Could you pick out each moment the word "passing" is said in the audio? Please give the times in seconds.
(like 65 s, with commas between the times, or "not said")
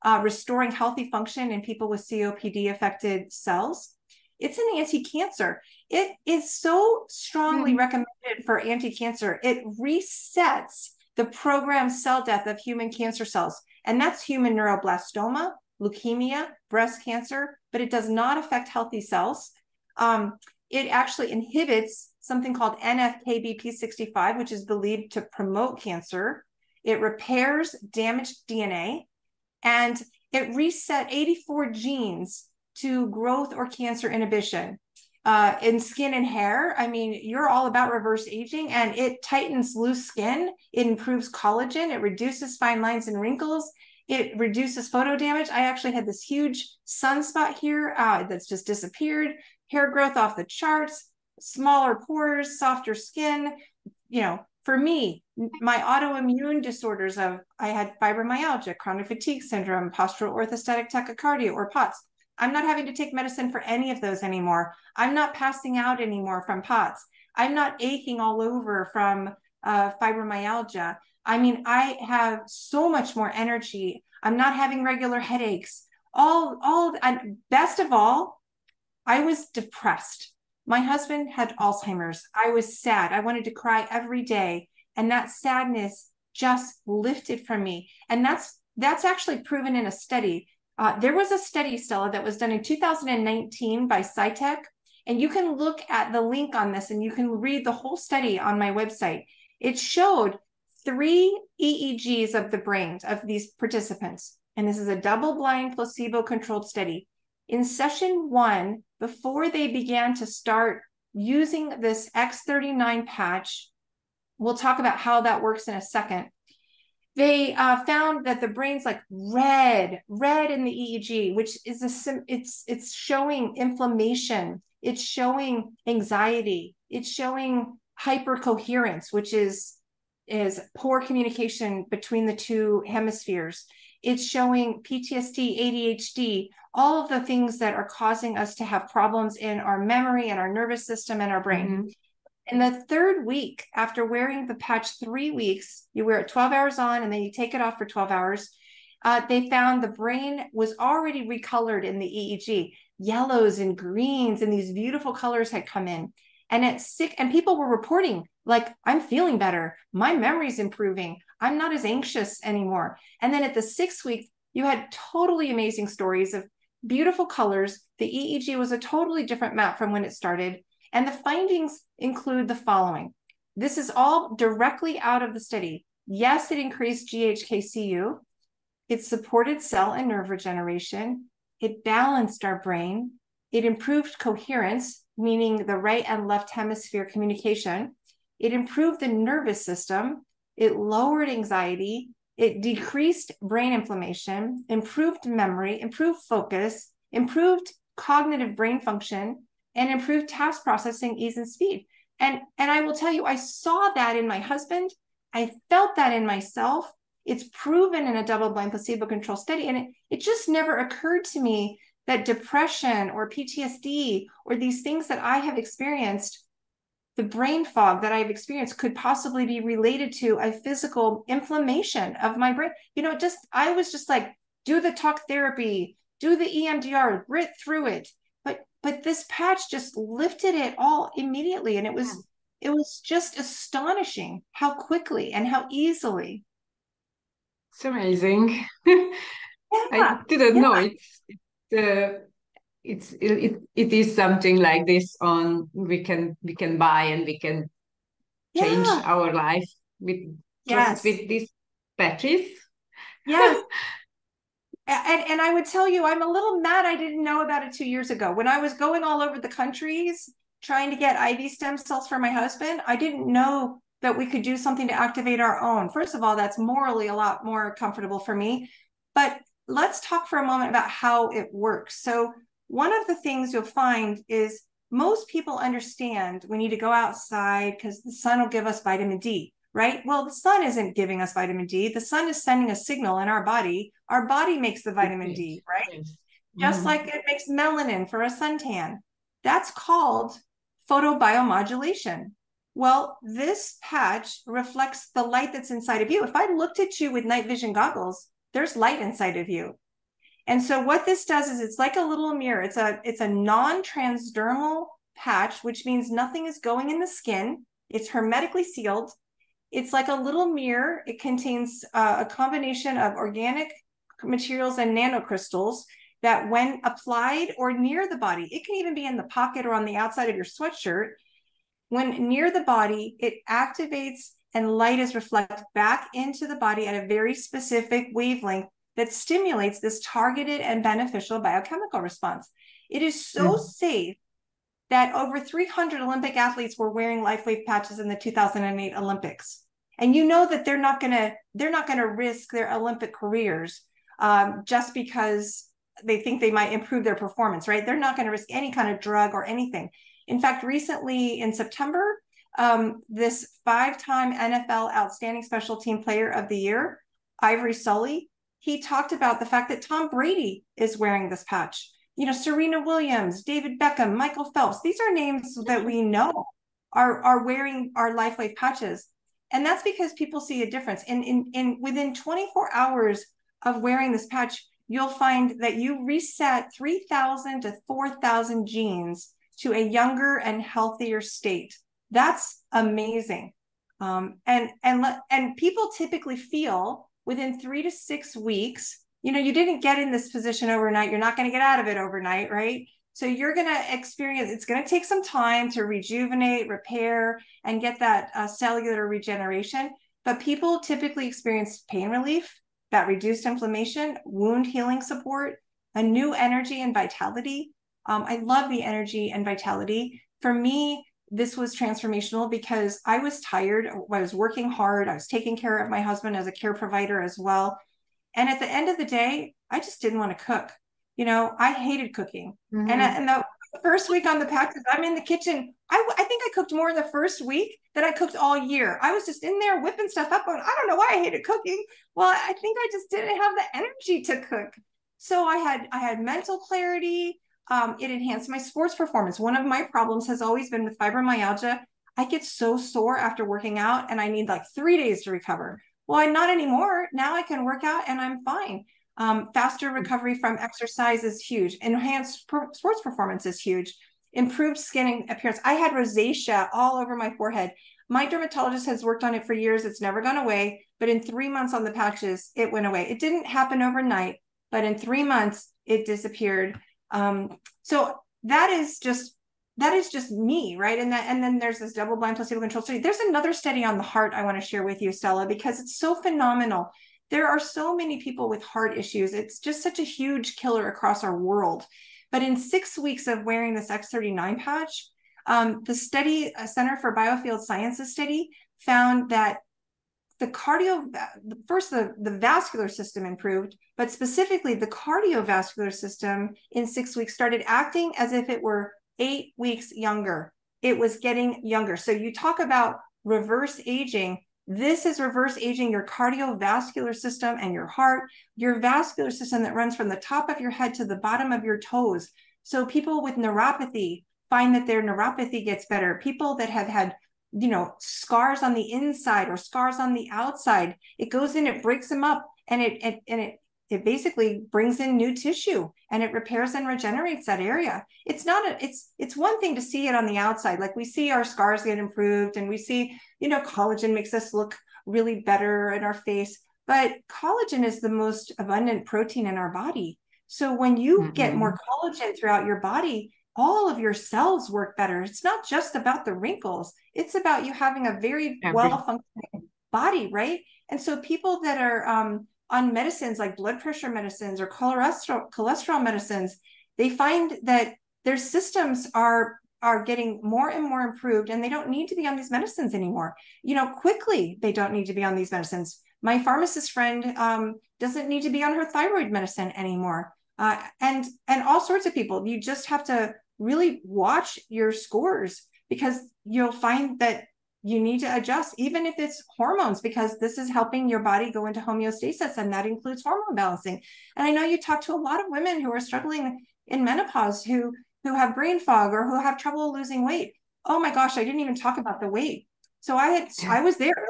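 65 s.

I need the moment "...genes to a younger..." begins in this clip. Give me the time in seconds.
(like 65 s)
378 s.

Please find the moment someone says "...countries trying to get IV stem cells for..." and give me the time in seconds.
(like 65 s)
259 s.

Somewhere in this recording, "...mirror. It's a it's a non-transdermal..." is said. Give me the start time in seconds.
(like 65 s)
302 s.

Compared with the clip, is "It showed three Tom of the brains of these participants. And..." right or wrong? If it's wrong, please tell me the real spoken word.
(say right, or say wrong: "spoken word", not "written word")
wrong: "EEGs", not "Tom".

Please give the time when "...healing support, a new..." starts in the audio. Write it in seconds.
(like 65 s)
404 s.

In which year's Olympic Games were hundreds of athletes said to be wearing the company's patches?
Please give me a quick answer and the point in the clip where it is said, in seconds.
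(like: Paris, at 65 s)
2008, at 338 s.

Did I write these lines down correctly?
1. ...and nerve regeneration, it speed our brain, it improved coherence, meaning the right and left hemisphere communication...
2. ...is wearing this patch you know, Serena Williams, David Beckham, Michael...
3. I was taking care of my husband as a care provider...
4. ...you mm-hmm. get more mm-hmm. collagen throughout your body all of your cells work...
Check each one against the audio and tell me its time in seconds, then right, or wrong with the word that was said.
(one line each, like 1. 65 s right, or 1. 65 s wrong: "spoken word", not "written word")
1. 179 s wrong: "balanced", not "speed"
2. 360 s right
3. 415 s right
4. 540 s right.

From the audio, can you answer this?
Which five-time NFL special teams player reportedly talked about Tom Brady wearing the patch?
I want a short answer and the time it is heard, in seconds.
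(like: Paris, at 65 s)
Ivory Sully, at 357 s.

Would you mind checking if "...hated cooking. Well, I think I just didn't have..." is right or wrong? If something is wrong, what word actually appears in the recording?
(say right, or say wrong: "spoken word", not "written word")
right.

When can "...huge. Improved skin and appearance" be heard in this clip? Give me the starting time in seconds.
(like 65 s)
453 s.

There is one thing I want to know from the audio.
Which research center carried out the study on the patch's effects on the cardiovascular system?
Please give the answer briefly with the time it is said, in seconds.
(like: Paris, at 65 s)
Center for Biofield Sciences, at 486 s.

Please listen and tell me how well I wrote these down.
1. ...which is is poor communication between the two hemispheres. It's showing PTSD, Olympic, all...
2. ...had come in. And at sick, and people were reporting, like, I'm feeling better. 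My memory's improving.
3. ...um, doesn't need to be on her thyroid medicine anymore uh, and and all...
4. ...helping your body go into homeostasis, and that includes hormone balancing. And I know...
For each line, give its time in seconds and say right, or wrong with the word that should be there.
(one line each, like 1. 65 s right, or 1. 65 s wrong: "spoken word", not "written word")
1. 129 s wrong: "ADHD", not "Olympic"
2. 155 s right
3. 567 s right
4. 580 s right.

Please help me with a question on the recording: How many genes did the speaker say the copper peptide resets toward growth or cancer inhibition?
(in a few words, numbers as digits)
84.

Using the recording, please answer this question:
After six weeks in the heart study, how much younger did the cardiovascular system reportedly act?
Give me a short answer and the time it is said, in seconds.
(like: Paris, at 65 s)
8 weeks younger, at 499 s.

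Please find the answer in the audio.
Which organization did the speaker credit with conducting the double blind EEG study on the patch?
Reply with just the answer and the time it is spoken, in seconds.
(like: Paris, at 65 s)
SciTech, at 94 s.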